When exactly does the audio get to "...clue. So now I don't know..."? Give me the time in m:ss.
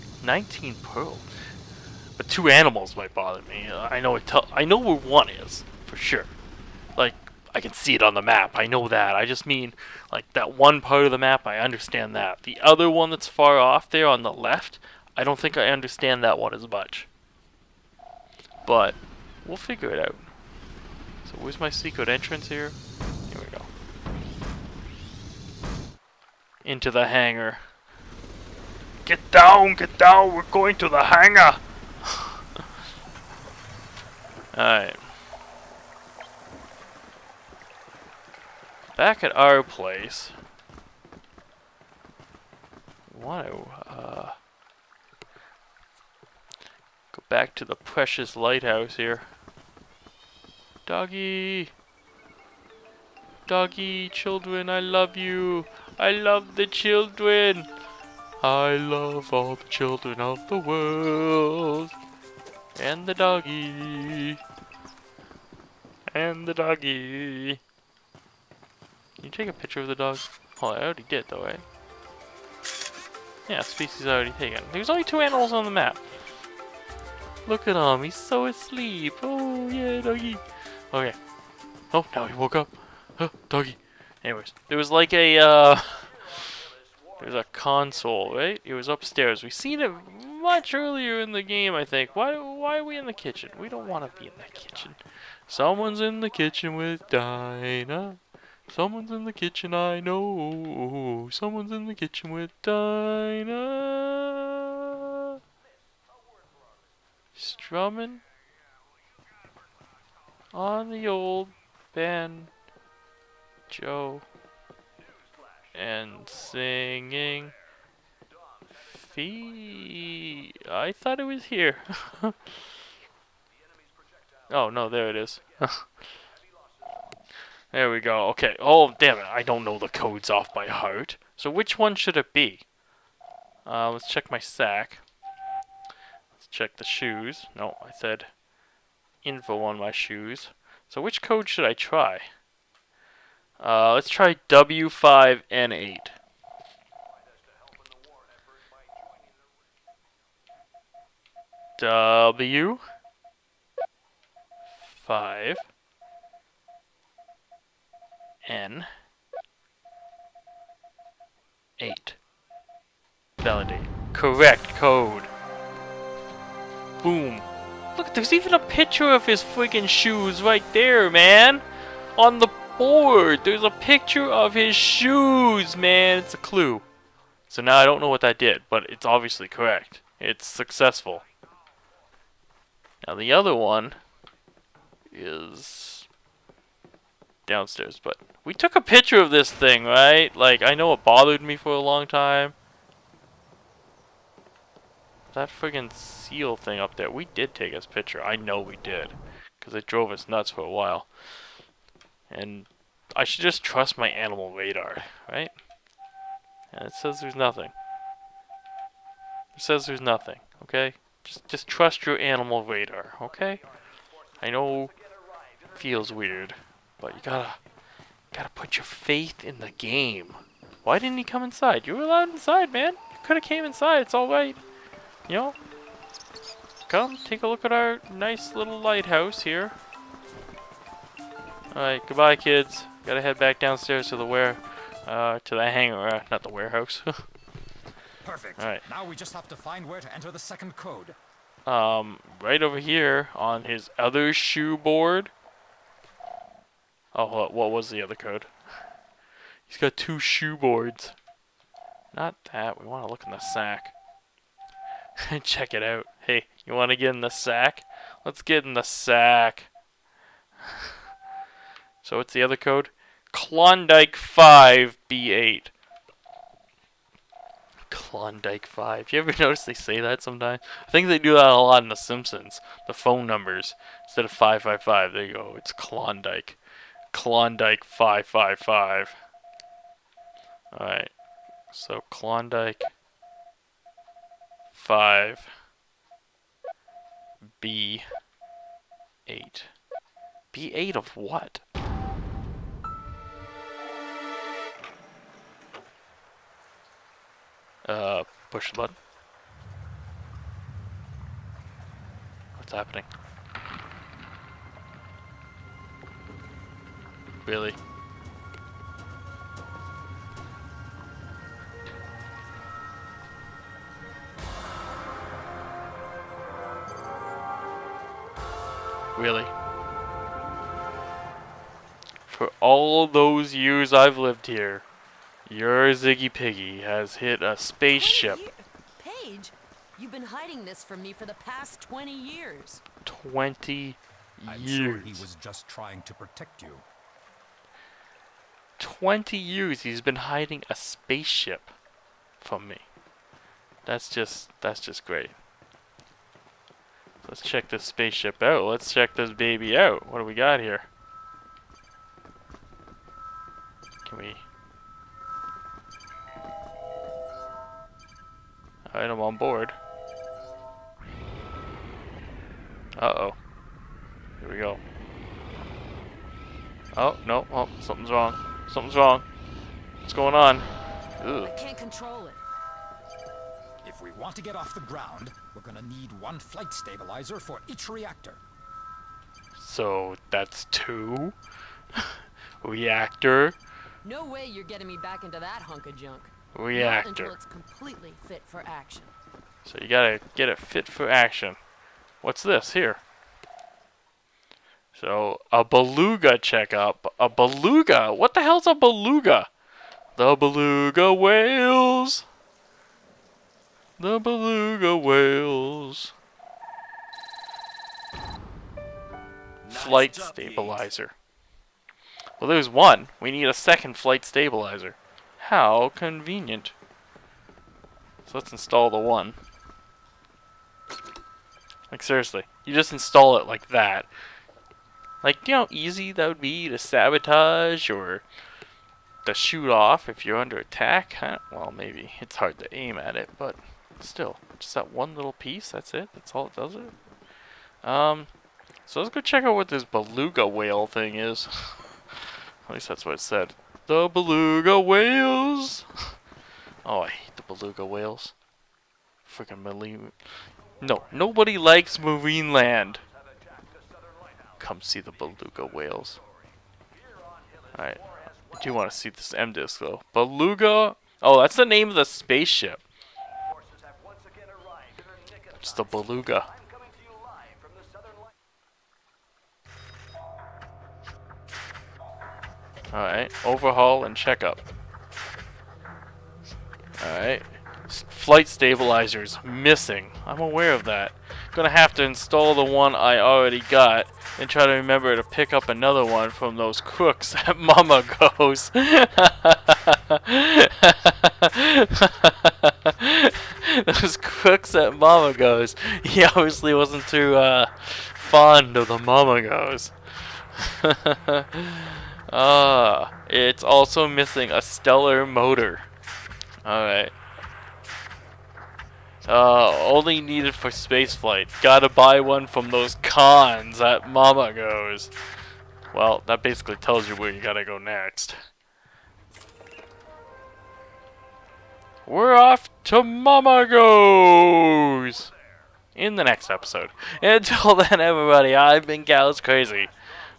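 2:56.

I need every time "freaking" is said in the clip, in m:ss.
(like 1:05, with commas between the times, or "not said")
2:49, 7:29.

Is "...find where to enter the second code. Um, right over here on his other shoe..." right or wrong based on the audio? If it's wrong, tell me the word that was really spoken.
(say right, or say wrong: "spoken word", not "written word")
right.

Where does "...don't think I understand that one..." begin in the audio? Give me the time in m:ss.
0:15.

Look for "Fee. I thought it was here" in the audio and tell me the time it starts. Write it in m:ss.
1:58.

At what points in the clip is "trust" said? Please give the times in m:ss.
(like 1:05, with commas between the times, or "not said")
3:23, 3:31.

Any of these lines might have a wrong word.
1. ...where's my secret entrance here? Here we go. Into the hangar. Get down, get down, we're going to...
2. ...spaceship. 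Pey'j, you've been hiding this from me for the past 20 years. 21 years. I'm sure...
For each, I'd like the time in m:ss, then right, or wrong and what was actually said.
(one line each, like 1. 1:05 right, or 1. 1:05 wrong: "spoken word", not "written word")
1. 0:21 right
2. 5:27 wrong: "20", not "21".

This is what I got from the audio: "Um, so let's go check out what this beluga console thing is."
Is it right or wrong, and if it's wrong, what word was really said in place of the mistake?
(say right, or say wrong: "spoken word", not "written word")
wrong: "whale", not "console".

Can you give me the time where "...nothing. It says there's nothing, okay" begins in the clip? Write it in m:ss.
3:27.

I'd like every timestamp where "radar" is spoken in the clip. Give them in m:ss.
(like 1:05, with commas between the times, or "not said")
3:24, 3:32.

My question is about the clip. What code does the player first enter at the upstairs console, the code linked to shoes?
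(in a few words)
W5N8.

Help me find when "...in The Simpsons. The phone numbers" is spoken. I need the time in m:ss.
4:31.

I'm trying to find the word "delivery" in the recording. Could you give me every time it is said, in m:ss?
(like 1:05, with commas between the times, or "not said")
not said.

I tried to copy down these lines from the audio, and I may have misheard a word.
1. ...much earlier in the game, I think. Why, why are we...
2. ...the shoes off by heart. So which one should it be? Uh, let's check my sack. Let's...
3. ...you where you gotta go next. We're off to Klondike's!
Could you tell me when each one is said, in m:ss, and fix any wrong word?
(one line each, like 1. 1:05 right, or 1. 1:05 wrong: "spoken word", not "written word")
1. 1:30 right
2. 2:09 wrong: "codes", not "shoes"
3. 8:37 wrong: "Mammago", not "Klondike".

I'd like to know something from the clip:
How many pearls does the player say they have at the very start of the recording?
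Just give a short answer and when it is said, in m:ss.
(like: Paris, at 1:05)
19, at 0:00.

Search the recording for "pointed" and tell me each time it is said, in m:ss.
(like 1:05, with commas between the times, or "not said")
not said.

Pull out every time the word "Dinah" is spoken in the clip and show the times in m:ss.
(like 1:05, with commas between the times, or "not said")
1:37, 1:42.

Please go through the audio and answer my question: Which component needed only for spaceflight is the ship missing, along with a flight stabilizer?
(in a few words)
stellar motor.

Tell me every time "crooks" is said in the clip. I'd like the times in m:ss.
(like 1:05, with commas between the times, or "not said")
8:06, 8:14.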